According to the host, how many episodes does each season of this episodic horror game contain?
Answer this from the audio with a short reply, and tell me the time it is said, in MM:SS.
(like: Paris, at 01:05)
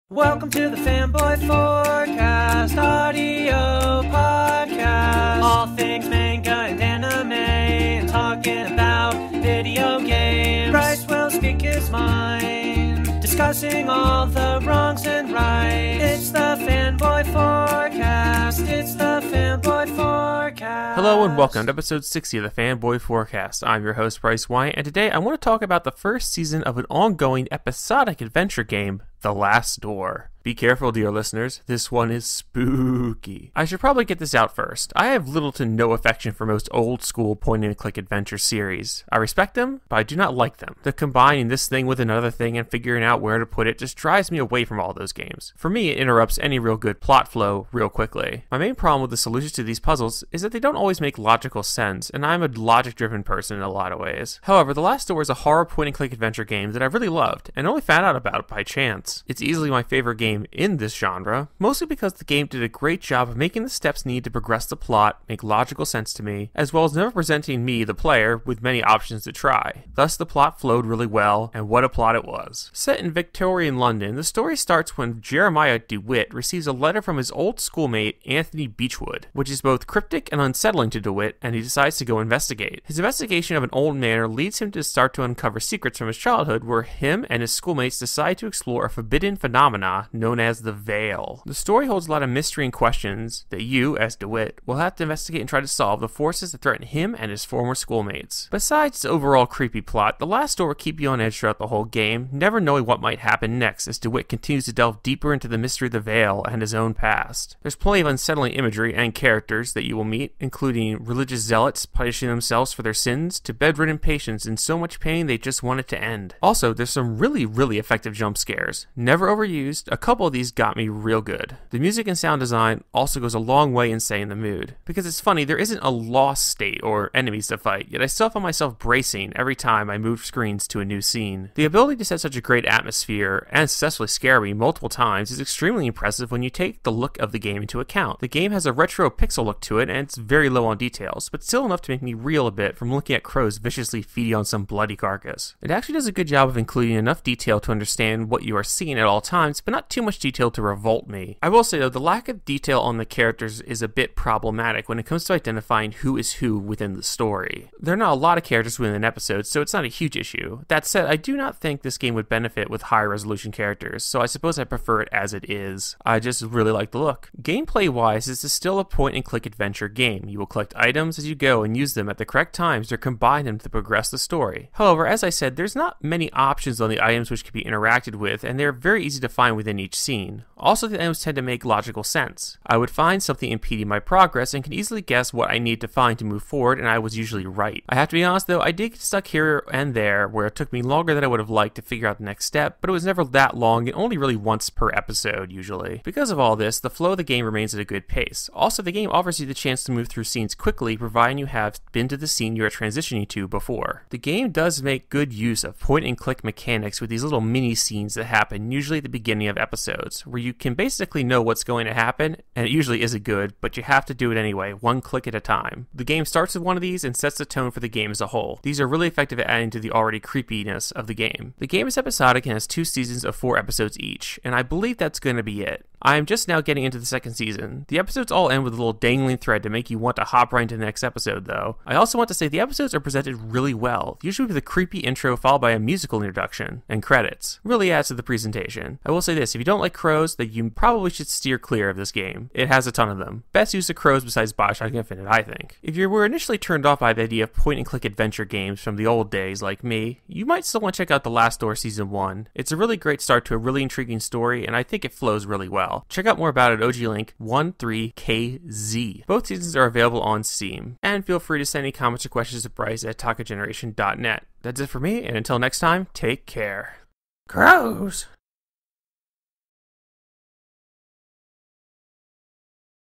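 4, at 03:43.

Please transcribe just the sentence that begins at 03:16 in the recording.
Because of all this, the flow of the game remains at a good pace.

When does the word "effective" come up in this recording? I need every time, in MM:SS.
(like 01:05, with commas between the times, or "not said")
01:57, 03:39.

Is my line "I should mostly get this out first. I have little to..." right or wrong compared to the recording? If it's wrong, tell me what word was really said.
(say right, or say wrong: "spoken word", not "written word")
wrong: "probably", not "mostly".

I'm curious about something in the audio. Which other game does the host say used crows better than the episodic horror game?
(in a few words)
Bioshock Infinite.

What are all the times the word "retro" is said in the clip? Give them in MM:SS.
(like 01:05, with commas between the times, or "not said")
02:18.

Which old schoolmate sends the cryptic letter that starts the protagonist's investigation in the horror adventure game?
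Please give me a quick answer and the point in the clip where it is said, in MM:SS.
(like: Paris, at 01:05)
Anthony Beechwood, at 01:18.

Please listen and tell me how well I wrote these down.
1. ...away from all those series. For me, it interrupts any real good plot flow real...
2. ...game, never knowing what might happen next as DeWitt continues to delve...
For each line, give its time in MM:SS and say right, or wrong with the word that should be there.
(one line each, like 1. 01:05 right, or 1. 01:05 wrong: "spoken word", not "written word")
1. 00:44 wrong: "games", not "series"
2. 01:41 right.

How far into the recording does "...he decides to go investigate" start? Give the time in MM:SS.
01:21.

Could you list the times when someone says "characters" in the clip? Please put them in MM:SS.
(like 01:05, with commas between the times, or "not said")
01:49, 02:33, 02:38, 02:43.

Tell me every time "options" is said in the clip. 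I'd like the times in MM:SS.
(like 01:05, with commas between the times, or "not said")
01:08, 02:56.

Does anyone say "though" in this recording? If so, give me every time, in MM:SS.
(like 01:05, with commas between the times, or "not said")
02:31, 03:08, 03:51.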